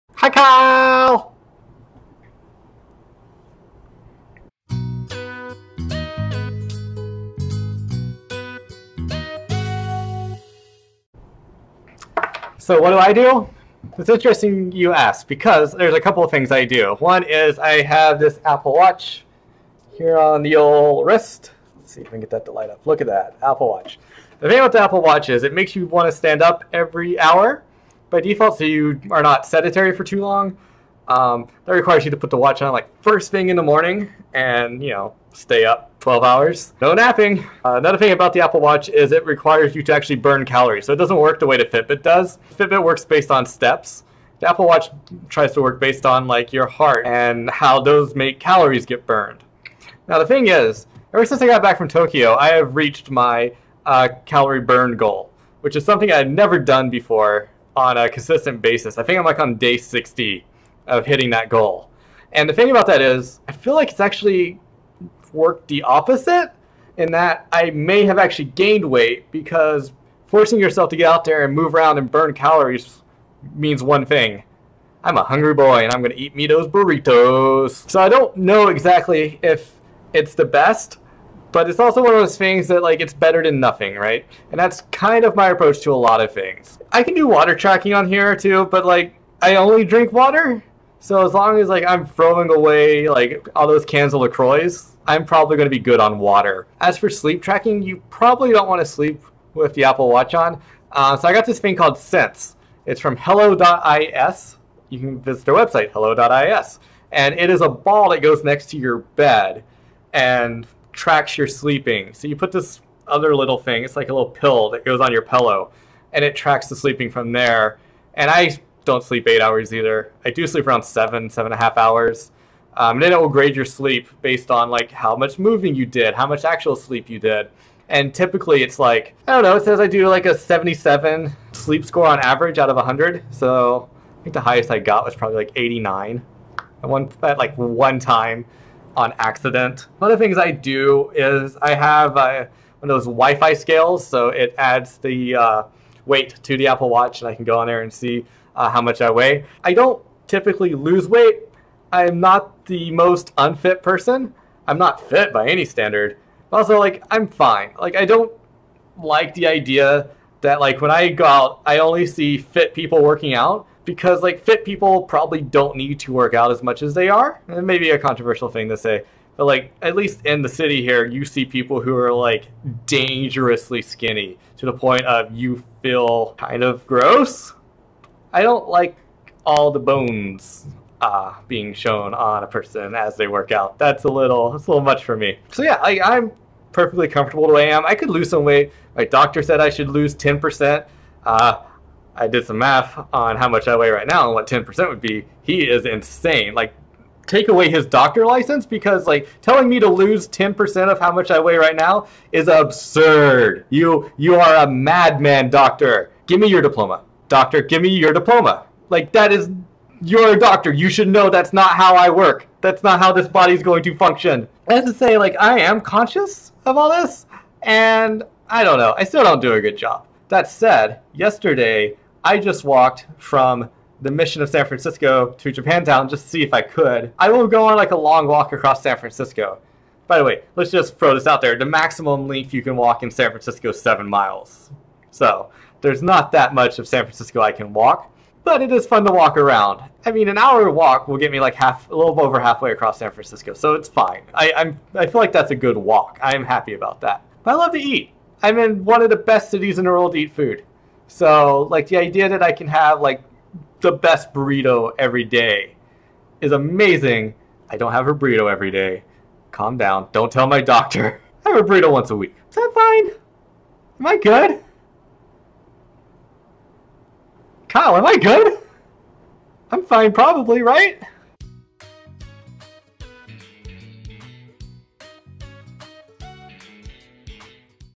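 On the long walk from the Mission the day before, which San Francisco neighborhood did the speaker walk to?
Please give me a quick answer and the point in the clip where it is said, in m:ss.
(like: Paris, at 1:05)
Japantown, at 3:45.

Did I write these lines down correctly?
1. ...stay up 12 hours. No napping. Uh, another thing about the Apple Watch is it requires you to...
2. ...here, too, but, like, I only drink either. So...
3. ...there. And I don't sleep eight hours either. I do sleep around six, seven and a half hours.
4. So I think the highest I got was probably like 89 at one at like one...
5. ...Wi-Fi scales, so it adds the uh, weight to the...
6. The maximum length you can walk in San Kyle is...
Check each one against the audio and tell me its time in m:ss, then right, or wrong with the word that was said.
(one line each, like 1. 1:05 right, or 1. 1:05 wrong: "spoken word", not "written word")
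1. 0:35 right
2. 1:28 wrong: "water", not "either"
3. 1:57 wrong: "seven", not "six"
4. 2:13 right
5. 2:23 right
6. 3:51 wrong: "Francisco", not "Kyle".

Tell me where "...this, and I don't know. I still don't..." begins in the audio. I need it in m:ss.
3:36.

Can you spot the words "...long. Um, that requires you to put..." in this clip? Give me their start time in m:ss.
0:30.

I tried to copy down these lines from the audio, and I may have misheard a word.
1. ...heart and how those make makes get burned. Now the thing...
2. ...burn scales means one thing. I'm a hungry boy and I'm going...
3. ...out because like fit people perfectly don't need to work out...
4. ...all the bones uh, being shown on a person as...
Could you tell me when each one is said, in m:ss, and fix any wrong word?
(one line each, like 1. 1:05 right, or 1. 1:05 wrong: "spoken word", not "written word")
1. 0:46 wrong: "calories", not "makes"
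2. 1:12 wrong: "calories", not "scales"
3. 2:43 wrong: "probably", not "perfectly"
4. 2:59 right.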